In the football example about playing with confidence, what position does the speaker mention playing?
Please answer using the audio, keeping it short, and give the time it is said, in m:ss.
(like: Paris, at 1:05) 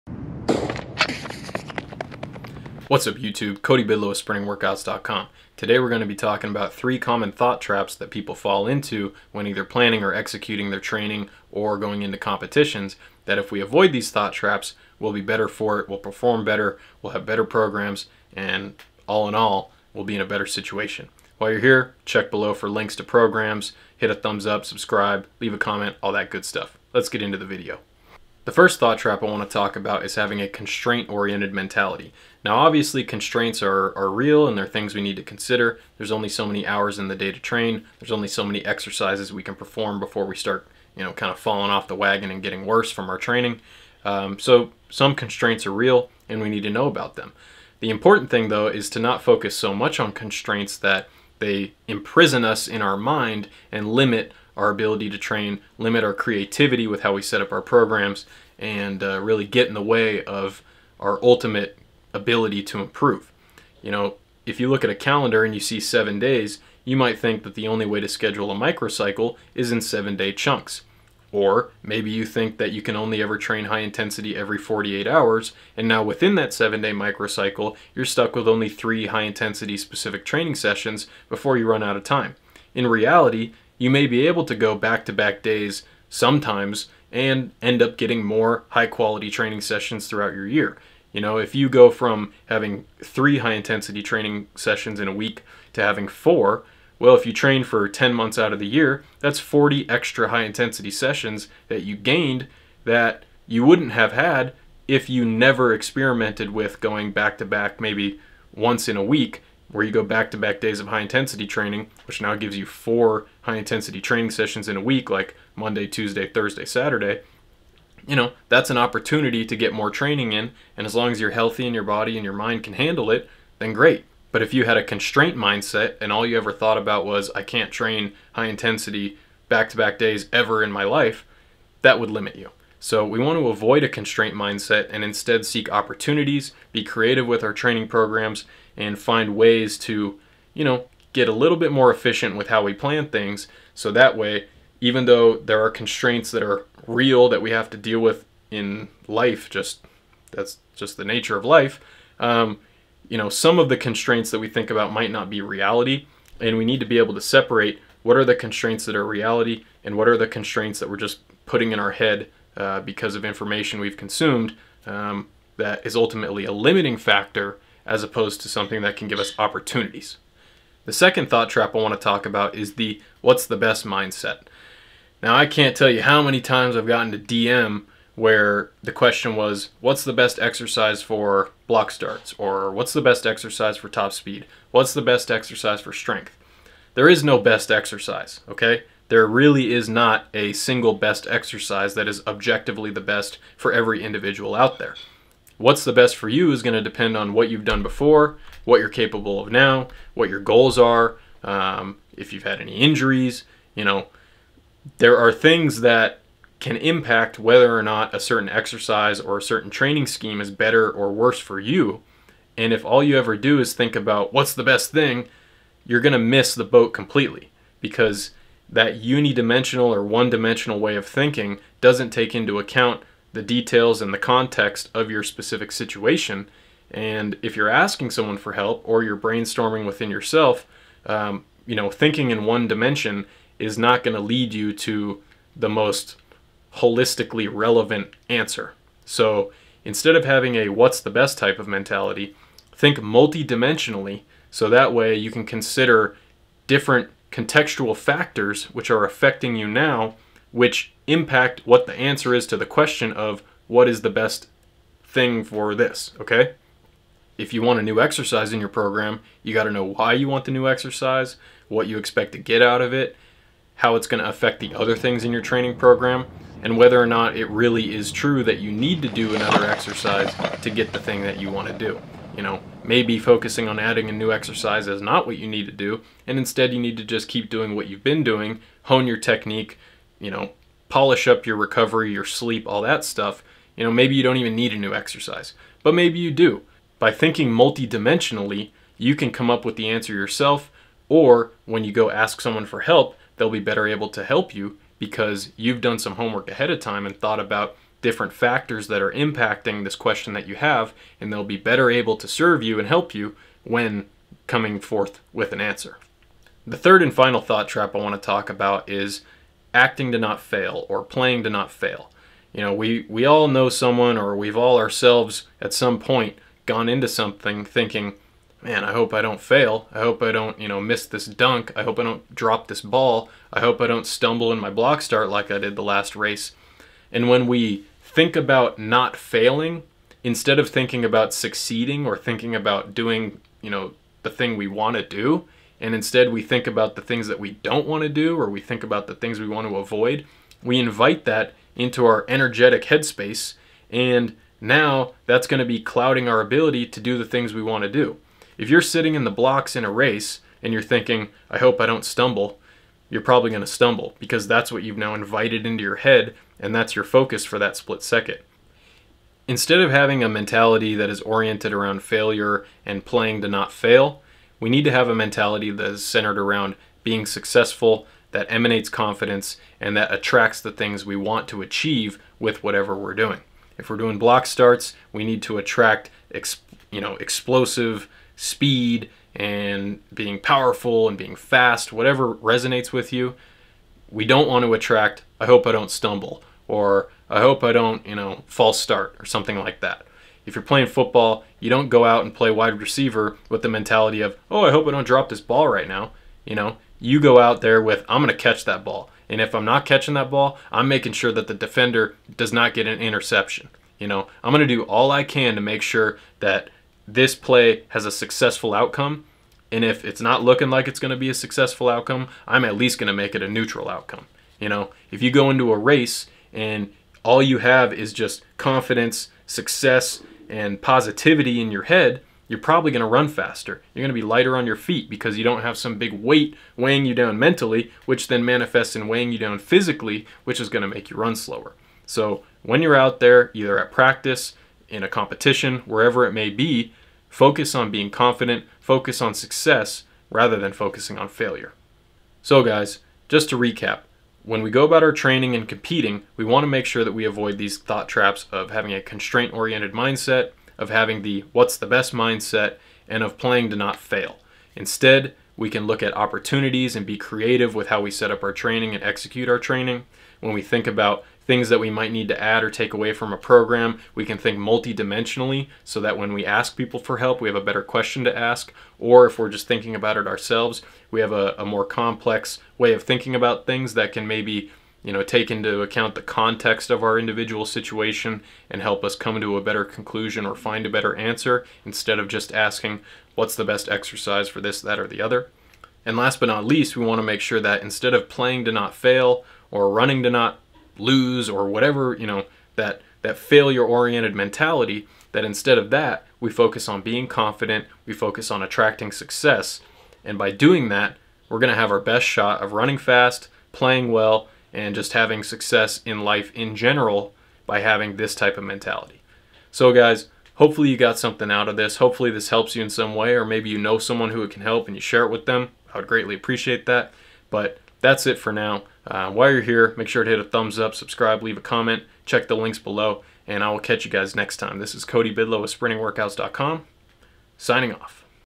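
Wide receiver, at 6:32.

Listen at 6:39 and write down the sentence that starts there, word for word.
And if I'm not catching that ball, I'm making sure that the defender does not get an interception.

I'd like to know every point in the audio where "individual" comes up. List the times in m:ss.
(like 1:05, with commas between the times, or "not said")
3:14, 7:57.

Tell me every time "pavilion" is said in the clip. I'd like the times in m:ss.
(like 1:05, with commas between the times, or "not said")
not said.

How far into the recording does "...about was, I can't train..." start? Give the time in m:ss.
2:06.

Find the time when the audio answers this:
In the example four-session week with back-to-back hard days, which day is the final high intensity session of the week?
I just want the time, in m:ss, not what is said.
1:56.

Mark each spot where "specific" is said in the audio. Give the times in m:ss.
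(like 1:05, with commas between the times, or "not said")
1:19, 3:45.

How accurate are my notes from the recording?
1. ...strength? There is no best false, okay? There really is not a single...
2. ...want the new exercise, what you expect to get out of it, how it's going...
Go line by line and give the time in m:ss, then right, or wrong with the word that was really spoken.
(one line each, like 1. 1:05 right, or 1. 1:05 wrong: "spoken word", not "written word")
1. 3:05 wrong: "exercise", not "false"
2. 4:20 right.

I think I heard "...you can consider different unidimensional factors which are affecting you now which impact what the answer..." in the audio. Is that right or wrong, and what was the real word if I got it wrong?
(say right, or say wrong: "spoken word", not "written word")
wrong: "contextual", not "unidimensional".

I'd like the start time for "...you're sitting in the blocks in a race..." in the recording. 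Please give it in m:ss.
5:48.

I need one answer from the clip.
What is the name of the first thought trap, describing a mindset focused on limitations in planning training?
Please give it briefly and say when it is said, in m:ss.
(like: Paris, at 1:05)
Constraint oriented mentality, at 0:30.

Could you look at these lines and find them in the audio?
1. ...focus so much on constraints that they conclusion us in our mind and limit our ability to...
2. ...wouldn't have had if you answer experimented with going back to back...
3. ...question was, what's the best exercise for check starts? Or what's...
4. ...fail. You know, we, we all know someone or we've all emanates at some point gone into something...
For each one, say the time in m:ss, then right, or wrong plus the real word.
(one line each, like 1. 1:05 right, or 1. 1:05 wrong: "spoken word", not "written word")
1. 0:49 wrong: "imprison", not "conclusion"
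2. 1:43 wrong: "never", not "answer"
3. 2:58 wrong: "block", not "check"
4. 5:11 wrong: "ourselves", not "emanates".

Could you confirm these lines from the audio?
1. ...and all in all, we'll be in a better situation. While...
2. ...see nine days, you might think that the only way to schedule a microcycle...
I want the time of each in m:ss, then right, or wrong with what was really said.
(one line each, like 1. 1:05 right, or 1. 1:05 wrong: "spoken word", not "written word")
1. 0:18 right
2. 1:05 wrong: "seven", not "nine".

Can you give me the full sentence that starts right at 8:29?
So, guys, hopefully you got something out of this.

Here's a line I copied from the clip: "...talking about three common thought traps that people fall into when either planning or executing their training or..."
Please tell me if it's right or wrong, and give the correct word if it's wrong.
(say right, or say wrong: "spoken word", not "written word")
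right.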